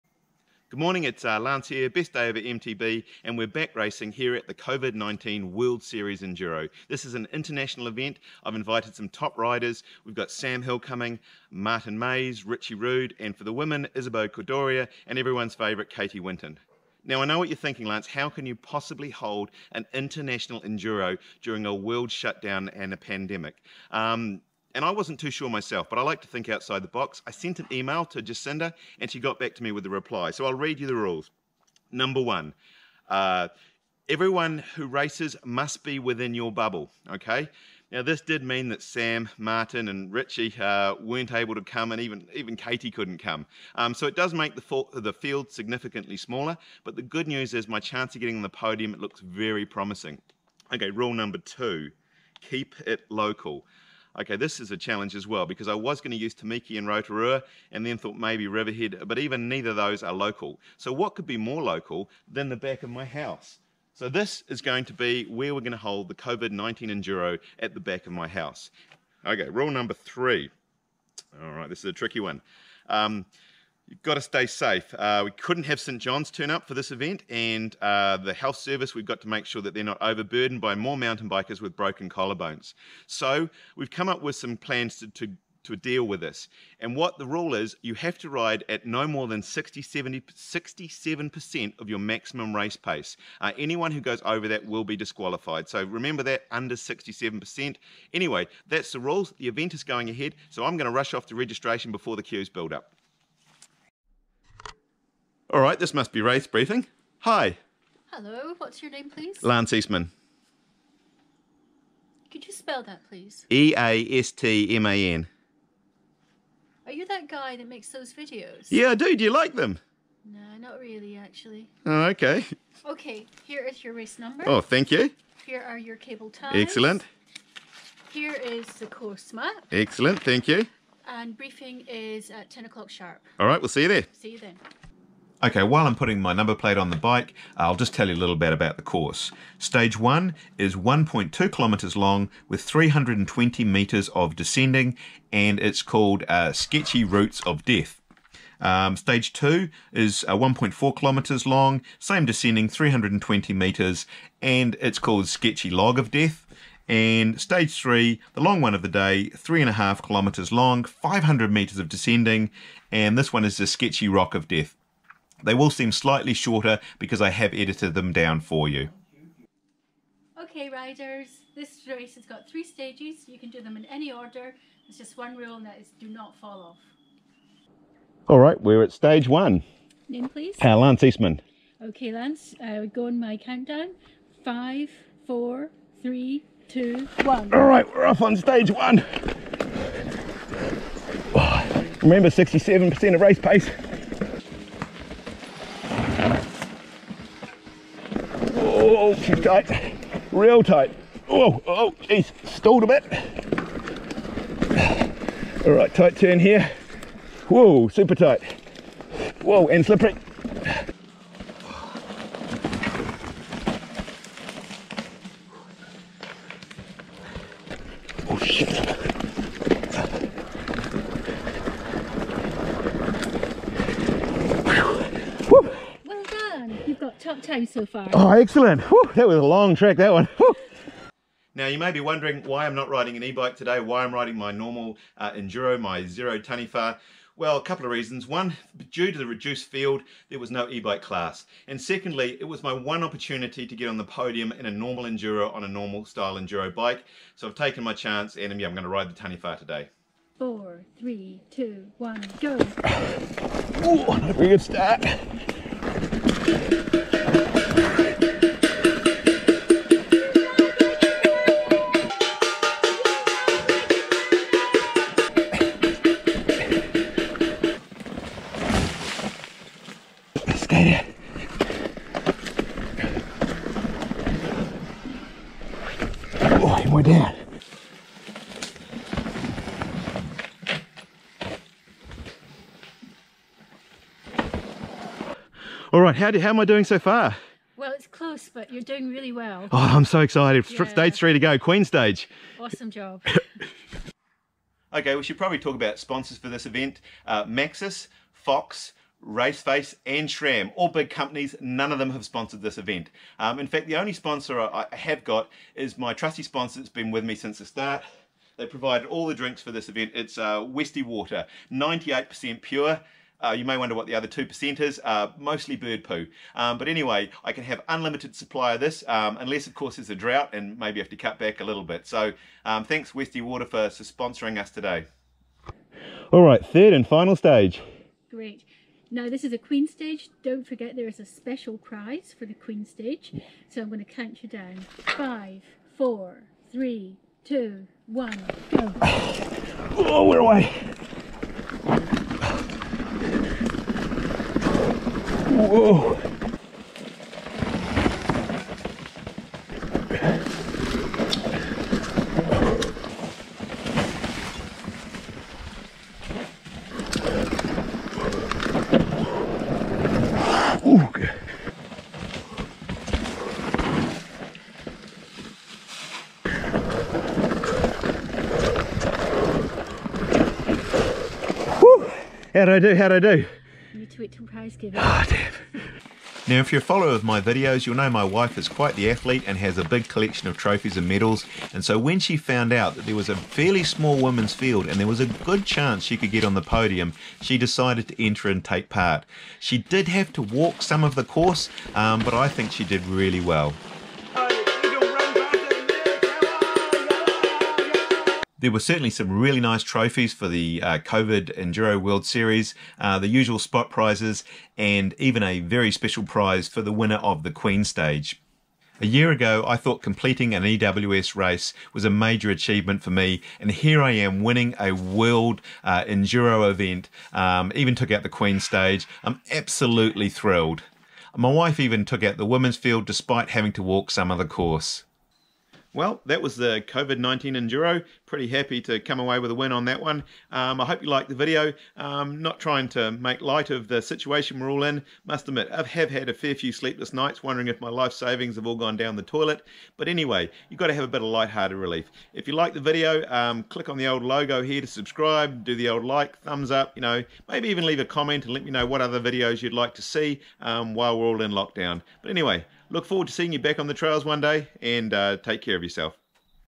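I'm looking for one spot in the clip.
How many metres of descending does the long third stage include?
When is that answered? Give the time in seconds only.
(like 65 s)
160 s.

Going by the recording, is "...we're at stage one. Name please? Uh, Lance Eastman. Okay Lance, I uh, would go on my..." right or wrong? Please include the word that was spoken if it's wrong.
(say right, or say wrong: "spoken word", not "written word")
right.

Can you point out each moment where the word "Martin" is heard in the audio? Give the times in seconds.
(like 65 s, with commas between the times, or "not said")
11 s, 39 s.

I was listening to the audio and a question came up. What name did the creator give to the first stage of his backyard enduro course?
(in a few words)
Sketchy Routes of Death.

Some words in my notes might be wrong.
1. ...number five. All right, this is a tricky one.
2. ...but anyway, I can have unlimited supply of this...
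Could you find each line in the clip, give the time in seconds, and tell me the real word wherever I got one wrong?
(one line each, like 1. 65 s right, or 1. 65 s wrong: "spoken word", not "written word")
1. 69 s wrong: "three", not "five"
2. 316 s right.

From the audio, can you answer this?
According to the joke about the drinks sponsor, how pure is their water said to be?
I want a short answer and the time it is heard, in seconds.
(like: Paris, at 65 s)
98%, at 311 s.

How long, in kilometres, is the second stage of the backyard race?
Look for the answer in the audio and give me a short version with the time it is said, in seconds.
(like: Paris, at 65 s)
1.4 kilometres, at 150 s.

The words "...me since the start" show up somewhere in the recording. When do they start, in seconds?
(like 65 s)
307 s.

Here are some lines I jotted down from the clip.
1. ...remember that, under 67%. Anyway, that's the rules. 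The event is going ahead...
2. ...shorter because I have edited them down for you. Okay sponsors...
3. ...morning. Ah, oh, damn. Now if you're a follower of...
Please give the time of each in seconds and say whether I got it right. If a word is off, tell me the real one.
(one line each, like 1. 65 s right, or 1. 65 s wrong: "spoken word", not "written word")
1. 95 s right
2. 166 s wrong: "riders", not "sponsors"
3. 374 s wrong: "giving", not "morning".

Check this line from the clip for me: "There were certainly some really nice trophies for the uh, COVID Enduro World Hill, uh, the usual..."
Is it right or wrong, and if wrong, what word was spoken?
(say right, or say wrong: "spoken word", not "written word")
wrong: "Series", not "Hill".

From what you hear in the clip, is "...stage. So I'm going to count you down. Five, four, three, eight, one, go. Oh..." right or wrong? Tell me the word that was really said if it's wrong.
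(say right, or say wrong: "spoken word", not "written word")
wrong: "two", not "eight".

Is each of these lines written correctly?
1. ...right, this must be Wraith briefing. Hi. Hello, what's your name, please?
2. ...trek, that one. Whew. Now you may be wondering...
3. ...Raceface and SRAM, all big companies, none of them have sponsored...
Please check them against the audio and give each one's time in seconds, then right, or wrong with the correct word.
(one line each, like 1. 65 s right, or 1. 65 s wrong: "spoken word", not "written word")
1. 105 s right
2. 229 s right
3. 299 s right.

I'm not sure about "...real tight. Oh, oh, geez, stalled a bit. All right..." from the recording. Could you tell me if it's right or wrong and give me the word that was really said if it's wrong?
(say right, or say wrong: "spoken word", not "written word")
right.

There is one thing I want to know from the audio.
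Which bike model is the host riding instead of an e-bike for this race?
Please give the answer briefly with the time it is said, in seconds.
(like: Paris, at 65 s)
Zerode Taniwha, at 236 s.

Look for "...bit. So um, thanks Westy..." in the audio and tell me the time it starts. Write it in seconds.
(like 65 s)
321 s.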